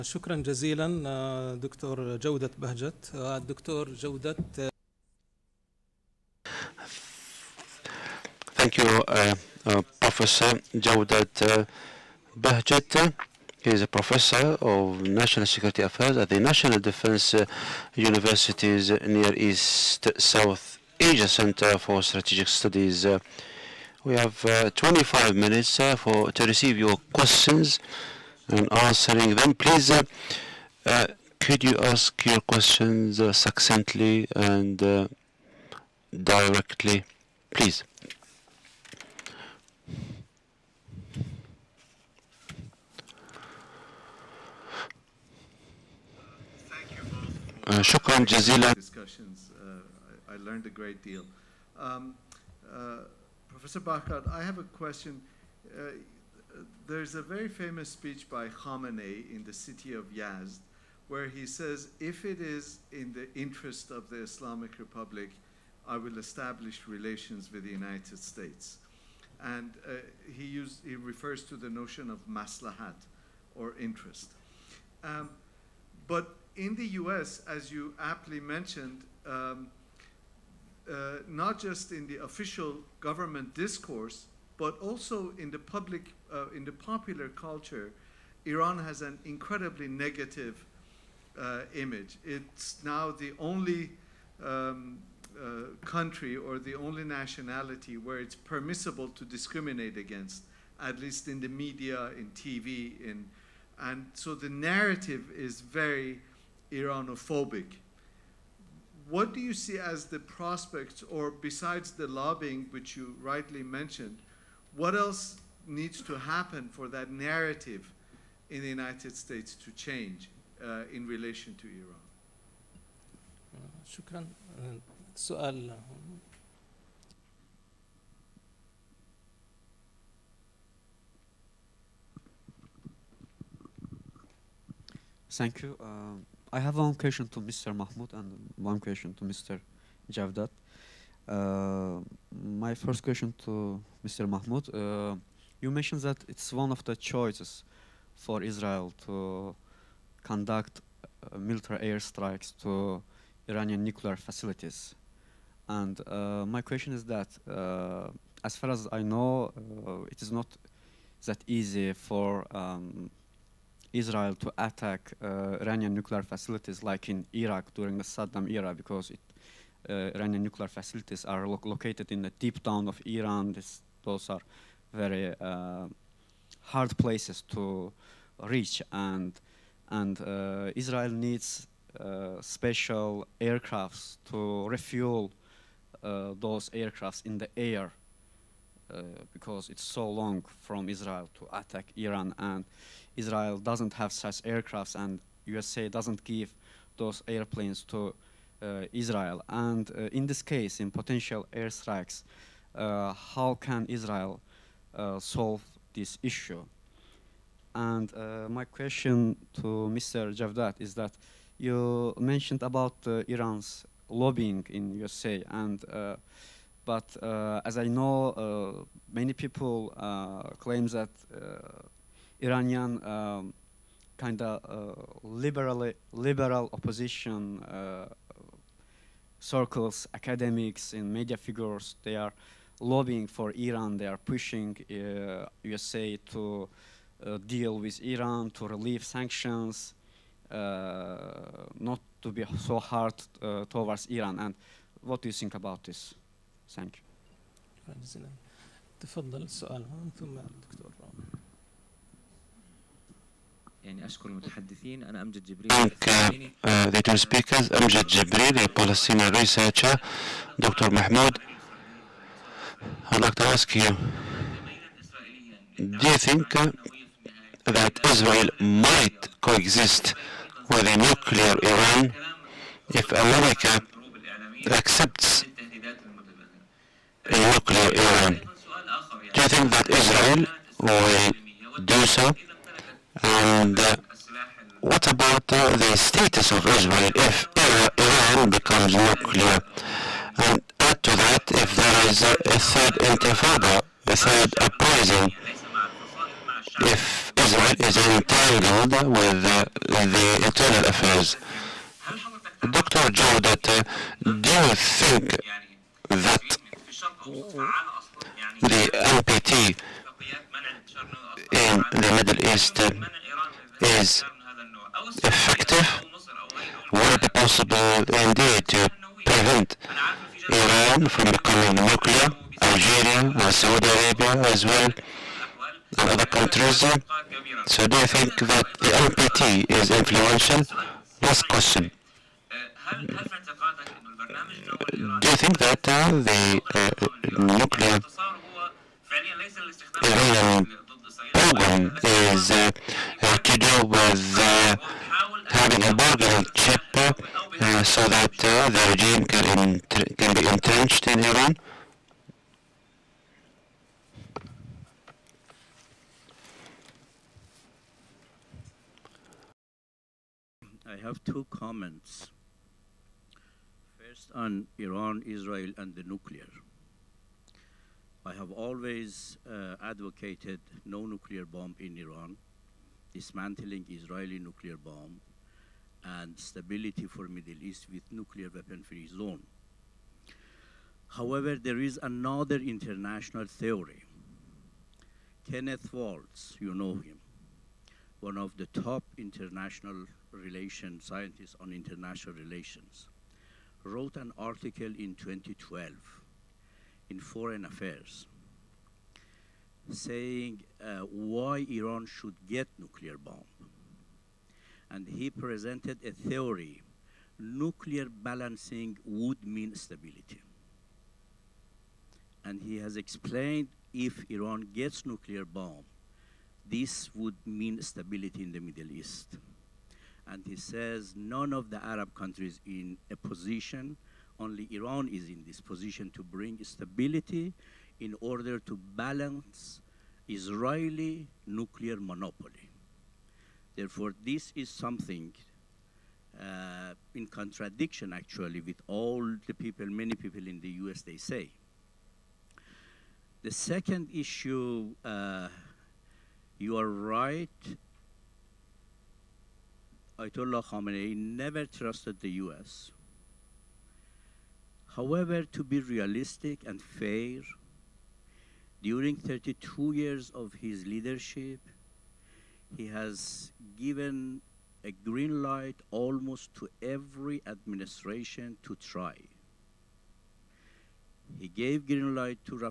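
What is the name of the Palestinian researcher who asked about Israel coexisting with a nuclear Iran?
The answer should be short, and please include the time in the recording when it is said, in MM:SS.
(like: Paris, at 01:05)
Amjad Jibril, at 04:17.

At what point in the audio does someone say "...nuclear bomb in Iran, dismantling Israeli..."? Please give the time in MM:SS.
06:11.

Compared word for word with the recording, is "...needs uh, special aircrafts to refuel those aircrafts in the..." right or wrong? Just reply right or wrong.
right.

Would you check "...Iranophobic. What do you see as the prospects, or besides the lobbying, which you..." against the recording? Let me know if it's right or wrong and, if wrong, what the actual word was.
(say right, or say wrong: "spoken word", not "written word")
right.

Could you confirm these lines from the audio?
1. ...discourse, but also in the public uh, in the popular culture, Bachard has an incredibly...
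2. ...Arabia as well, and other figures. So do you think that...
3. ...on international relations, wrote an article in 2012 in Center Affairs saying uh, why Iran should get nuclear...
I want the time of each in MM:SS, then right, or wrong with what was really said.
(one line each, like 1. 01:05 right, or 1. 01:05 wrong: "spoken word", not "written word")
1. 01:23 wrong: "Iran", not "Bachard"
2. 05:23 wrong: "countries", not "figures"
3. 06:31 wrong: "Foreign", not "Center".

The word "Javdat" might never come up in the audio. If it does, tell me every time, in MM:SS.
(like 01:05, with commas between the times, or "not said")
02:20, 03:30.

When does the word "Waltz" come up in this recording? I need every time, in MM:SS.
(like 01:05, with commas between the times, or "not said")
06:25.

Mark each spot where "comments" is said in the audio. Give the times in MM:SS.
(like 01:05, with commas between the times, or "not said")
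06:01.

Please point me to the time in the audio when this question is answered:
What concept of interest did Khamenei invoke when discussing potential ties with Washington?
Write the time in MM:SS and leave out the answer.
01:12.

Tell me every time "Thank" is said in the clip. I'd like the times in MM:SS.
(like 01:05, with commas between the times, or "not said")
00:08, 02:15, 04:06, 04:15.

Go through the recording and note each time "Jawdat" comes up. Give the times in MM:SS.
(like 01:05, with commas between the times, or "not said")
00:10, 05:03.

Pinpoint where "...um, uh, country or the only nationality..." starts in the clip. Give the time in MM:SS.
01:34.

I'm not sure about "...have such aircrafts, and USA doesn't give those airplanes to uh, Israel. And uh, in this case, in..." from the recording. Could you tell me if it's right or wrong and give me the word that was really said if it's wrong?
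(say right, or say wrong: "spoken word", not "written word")
right.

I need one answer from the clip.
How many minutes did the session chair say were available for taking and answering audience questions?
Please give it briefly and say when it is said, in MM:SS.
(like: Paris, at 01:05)
25, at 00:24.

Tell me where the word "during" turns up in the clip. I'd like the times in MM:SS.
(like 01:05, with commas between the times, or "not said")
02:47, 07:38.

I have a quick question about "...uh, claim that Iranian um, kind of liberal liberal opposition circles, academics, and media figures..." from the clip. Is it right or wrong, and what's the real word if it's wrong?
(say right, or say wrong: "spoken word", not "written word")
right.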